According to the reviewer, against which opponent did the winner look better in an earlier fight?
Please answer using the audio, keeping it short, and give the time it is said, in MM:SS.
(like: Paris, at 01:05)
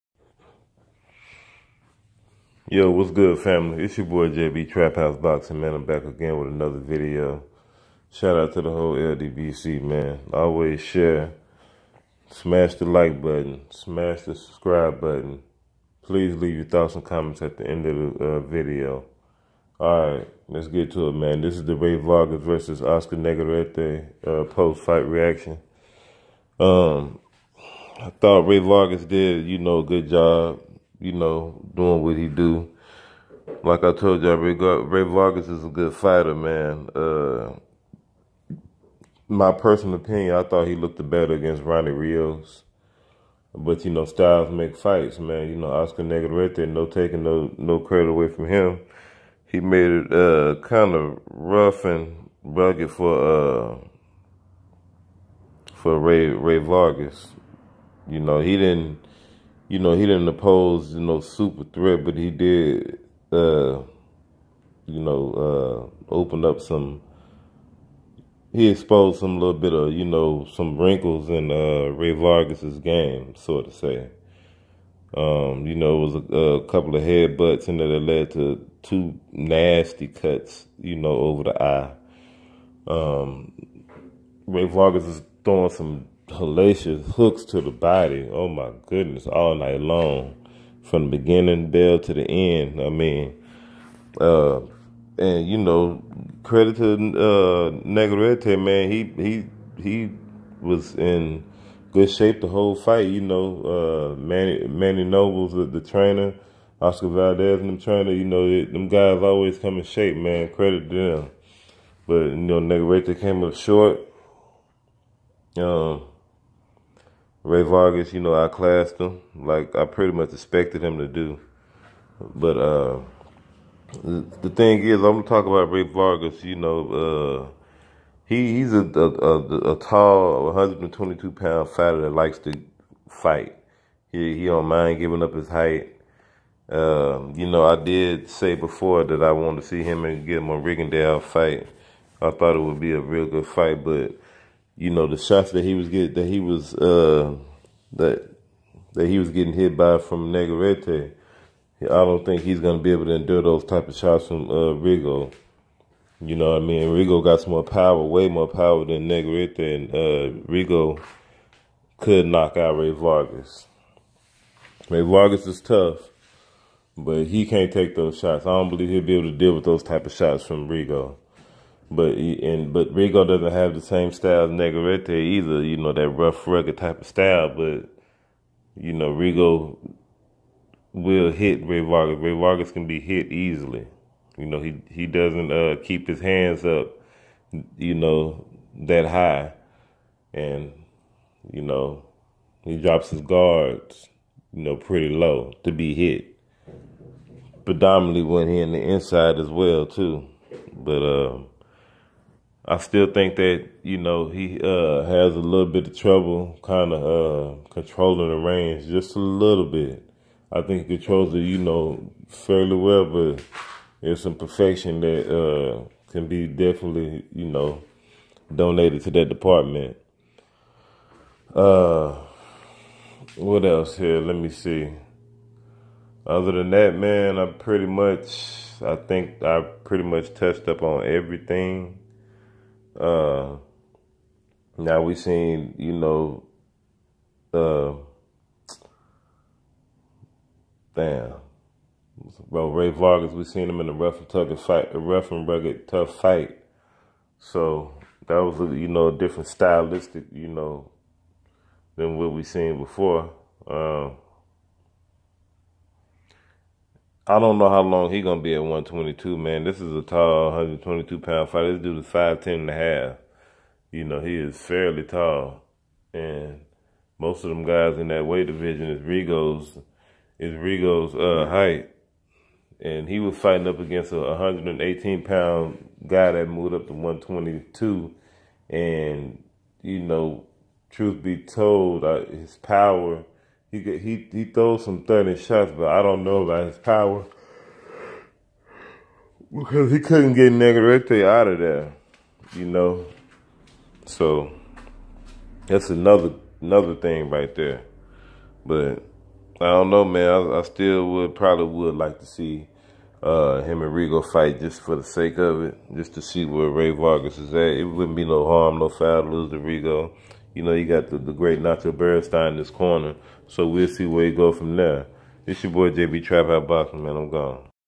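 Ronnie Rios, at 00:41.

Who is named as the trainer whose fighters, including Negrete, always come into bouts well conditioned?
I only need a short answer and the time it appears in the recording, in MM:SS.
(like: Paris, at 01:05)
Manny Robles, at 01:44.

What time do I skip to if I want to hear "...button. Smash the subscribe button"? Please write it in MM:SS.
00:13.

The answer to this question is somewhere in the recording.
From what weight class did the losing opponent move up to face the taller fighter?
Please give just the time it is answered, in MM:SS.
04:34.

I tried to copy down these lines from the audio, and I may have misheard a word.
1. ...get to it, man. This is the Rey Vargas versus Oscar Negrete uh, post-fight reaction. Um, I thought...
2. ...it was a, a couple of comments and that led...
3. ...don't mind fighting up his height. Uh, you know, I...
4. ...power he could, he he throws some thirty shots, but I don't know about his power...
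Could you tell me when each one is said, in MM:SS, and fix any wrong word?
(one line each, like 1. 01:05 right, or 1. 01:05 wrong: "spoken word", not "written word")
1. 00:20 right
2. 01:16 wrong: "headbutts", not "comments"
3. 02:14 wrong: "giving", not "fighting"
4. 04:42 right.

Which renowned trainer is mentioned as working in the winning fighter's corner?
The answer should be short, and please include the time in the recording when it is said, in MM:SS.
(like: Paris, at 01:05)
Nacho Beristain, at 05:11.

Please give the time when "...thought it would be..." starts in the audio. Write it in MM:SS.
02:22.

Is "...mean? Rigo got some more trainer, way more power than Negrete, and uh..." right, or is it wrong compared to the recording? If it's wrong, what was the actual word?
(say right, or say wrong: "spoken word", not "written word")
wrong: "power", not "trainer".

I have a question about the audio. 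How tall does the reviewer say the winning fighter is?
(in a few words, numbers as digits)
5'10 and a half.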